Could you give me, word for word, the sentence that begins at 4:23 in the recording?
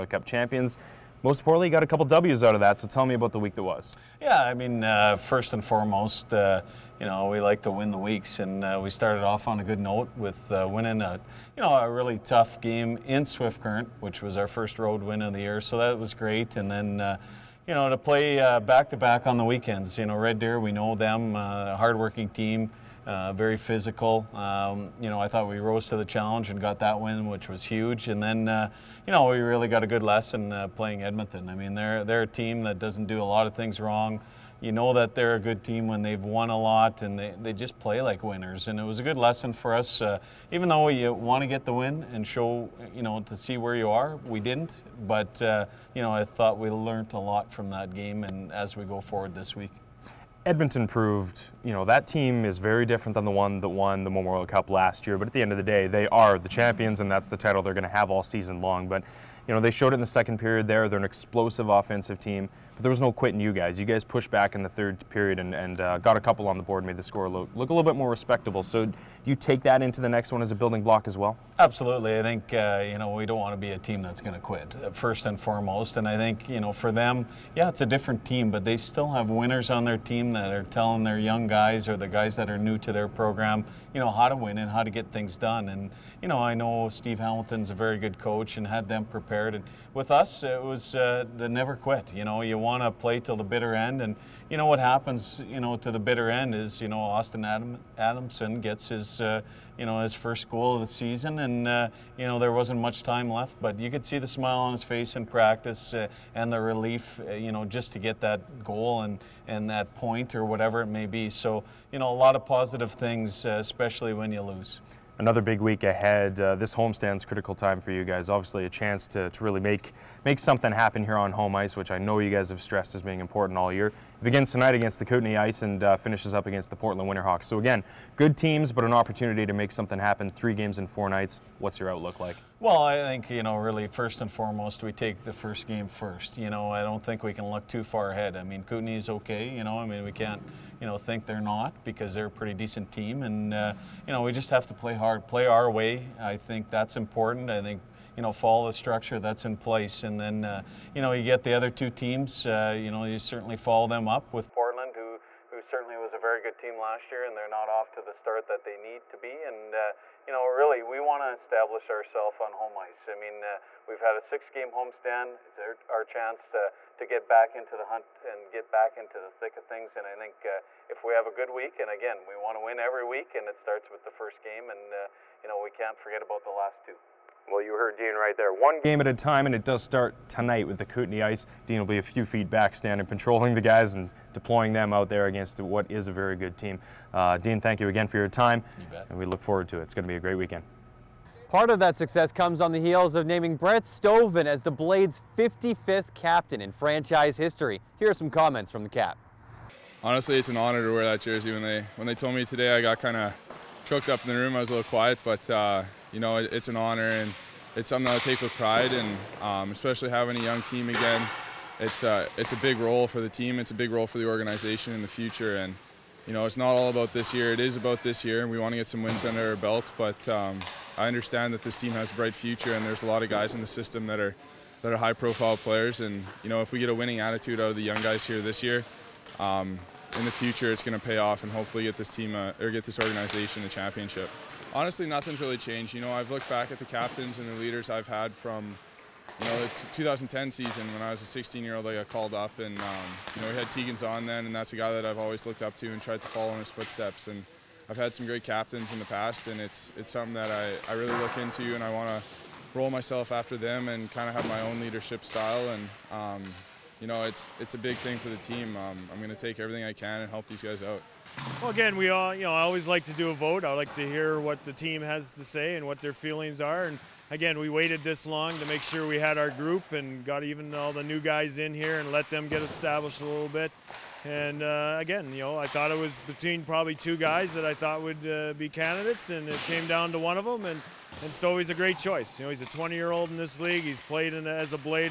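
I like to hear what the team has to say and what their feelings are.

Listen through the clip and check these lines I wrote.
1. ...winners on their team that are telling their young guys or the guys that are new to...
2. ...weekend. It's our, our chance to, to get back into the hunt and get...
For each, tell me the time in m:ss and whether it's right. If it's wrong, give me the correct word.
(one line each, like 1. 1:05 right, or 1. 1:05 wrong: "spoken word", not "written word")
1. 1:19 right
2. 2:44 wrong: "homestand", not "weekend".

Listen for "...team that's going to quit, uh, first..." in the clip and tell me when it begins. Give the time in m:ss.
1:13.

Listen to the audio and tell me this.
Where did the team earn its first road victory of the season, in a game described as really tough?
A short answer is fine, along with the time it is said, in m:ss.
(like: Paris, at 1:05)
Swift Current, at 0:13.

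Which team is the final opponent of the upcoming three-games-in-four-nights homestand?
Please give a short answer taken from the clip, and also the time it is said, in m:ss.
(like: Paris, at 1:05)
Portland Winterhawks, at 2:06.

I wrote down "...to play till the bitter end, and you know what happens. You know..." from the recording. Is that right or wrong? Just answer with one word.
right.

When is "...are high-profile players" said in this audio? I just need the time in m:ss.
3:44.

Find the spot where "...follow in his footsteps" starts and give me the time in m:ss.
4:06.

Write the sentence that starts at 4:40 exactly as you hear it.
And and is a great choice.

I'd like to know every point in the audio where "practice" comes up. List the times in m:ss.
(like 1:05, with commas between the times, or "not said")
1:45.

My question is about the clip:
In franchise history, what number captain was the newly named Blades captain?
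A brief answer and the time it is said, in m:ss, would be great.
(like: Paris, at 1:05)
55th, at 3:15.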